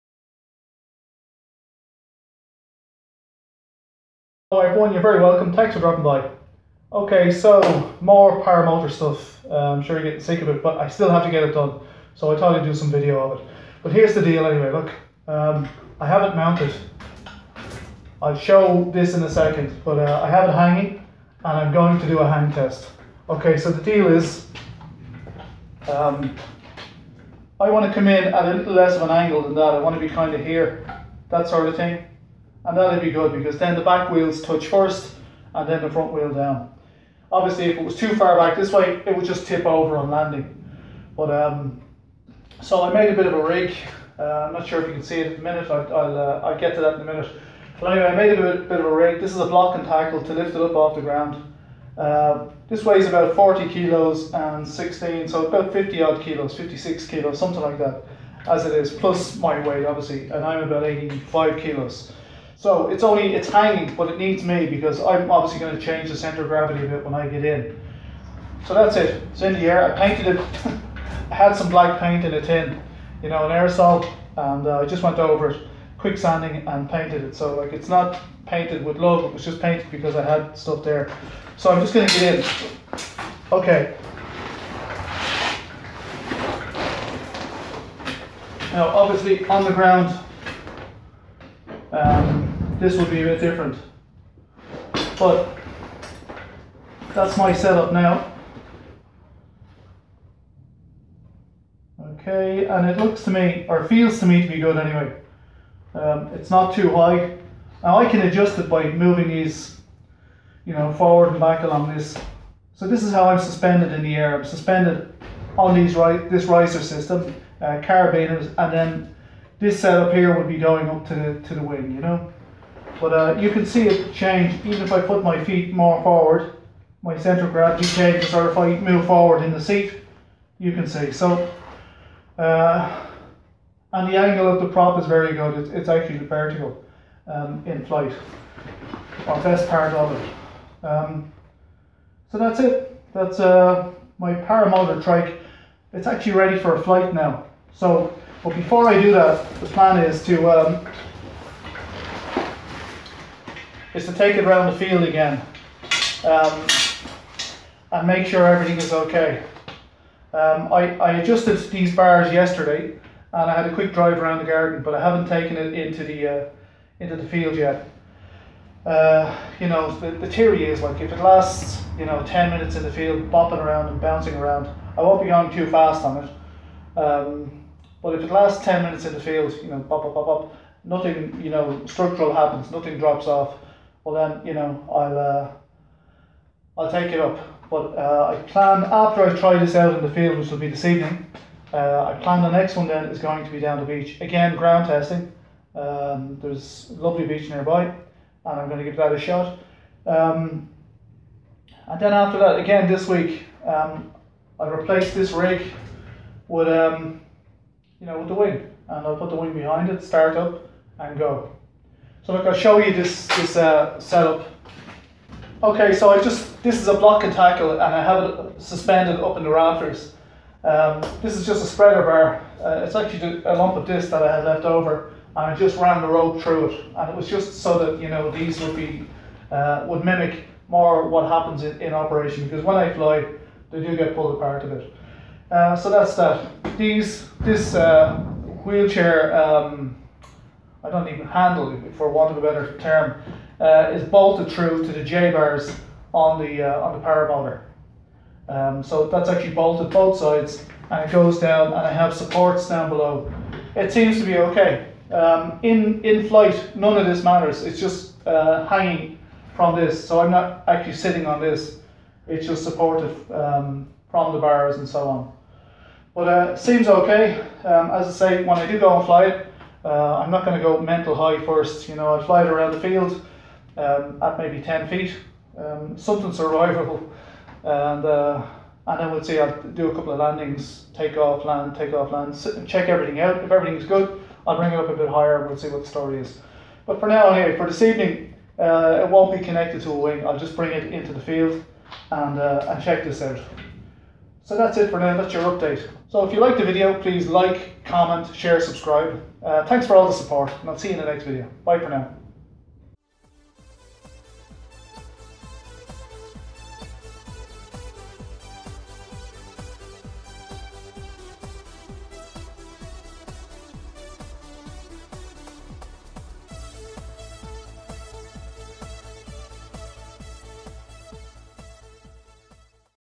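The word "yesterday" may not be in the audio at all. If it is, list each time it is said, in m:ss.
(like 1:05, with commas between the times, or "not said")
2:42.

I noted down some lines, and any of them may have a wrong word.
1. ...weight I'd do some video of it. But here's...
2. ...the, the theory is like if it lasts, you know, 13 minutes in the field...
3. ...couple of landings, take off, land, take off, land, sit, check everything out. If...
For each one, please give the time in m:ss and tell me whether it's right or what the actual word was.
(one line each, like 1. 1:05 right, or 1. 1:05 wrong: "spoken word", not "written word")
1. 0:12 wrong: "thought", not "weight"
2. 2:49 wrong: "10", not "13"
3. 4:39 right.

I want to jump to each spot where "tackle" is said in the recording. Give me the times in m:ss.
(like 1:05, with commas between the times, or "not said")
0:49, 3:37.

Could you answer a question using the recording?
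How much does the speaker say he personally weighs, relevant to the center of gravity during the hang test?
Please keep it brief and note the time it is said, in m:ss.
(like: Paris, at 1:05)
85 kilos, at 1:00.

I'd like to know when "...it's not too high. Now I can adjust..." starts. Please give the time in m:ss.
1:46.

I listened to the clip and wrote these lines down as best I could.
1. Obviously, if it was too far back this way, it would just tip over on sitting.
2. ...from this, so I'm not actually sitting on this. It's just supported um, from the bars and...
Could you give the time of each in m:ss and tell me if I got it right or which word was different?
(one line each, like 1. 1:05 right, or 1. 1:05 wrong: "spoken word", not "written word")
1. 0:37 wrong: "landing", not "sitting"
2. 4:19 right.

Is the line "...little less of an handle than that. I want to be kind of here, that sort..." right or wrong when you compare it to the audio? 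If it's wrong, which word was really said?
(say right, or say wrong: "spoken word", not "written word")
wrong: "angle", not "handle".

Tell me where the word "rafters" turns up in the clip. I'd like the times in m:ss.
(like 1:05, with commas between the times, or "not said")
3:39.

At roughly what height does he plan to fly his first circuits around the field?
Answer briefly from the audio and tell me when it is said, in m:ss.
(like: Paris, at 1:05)
10 feet, at 4:34.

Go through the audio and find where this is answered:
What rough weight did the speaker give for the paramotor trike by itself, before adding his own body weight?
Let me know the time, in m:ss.
0:56.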